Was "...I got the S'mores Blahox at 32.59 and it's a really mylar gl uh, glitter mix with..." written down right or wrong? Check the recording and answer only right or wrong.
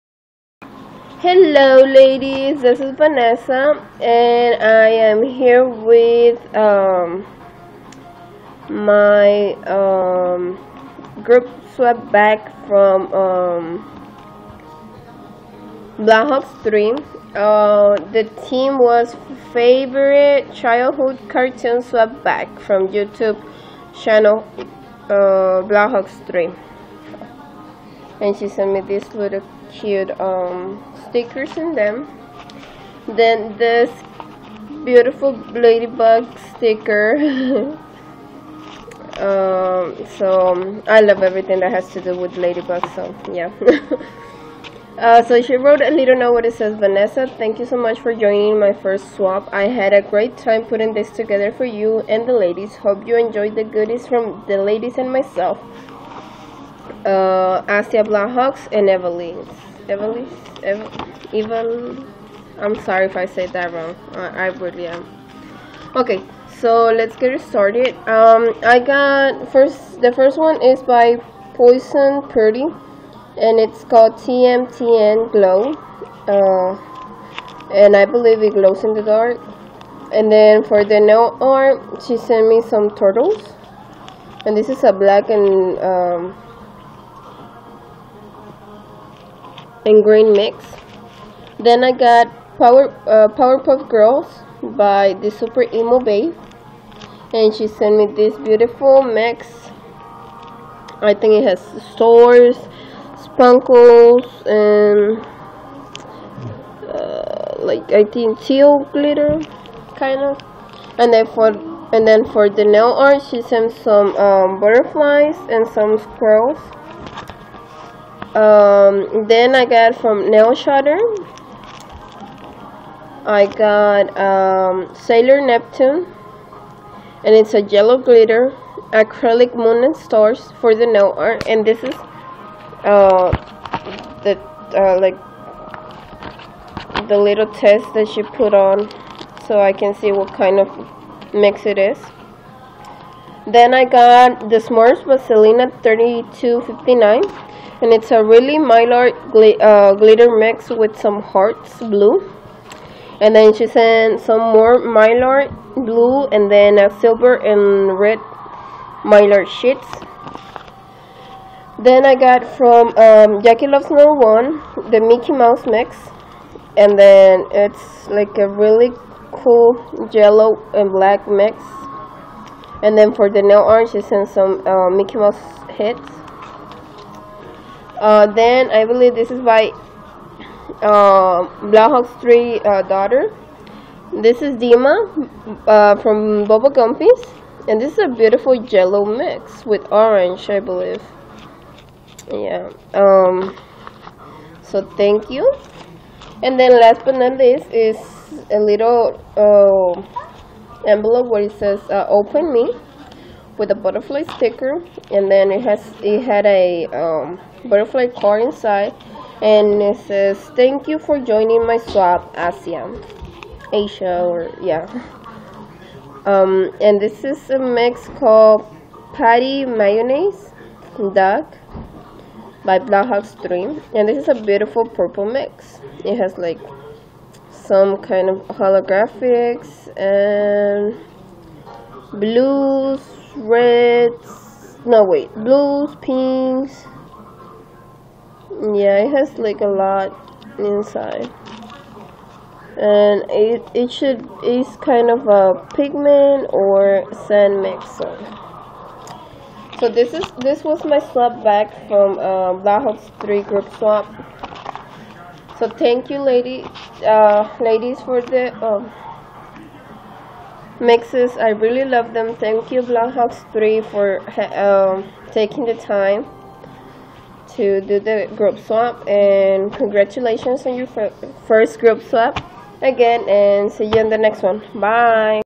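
wrong.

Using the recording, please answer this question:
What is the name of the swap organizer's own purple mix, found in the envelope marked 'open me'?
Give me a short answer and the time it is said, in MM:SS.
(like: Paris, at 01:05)
Patti Mayonnaise Doug, at 03:39.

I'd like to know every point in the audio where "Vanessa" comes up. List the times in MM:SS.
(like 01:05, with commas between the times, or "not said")
00:02, 00:46.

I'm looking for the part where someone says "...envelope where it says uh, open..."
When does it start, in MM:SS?
03:20.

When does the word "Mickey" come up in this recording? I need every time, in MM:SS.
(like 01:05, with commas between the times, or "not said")
02:45, 02:54.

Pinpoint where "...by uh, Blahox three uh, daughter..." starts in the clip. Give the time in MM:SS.
02:59.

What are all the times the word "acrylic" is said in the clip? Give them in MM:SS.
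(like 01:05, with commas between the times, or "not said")
02:08.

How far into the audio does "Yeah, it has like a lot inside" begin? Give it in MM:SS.
03:58.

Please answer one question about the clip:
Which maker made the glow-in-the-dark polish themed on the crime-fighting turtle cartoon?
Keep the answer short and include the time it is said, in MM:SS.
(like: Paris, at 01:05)
Poison Purdy, at 01:11.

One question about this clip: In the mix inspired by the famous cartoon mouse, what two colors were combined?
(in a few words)
Yellow and black.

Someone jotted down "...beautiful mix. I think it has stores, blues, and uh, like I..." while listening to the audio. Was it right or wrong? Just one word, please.
wrong.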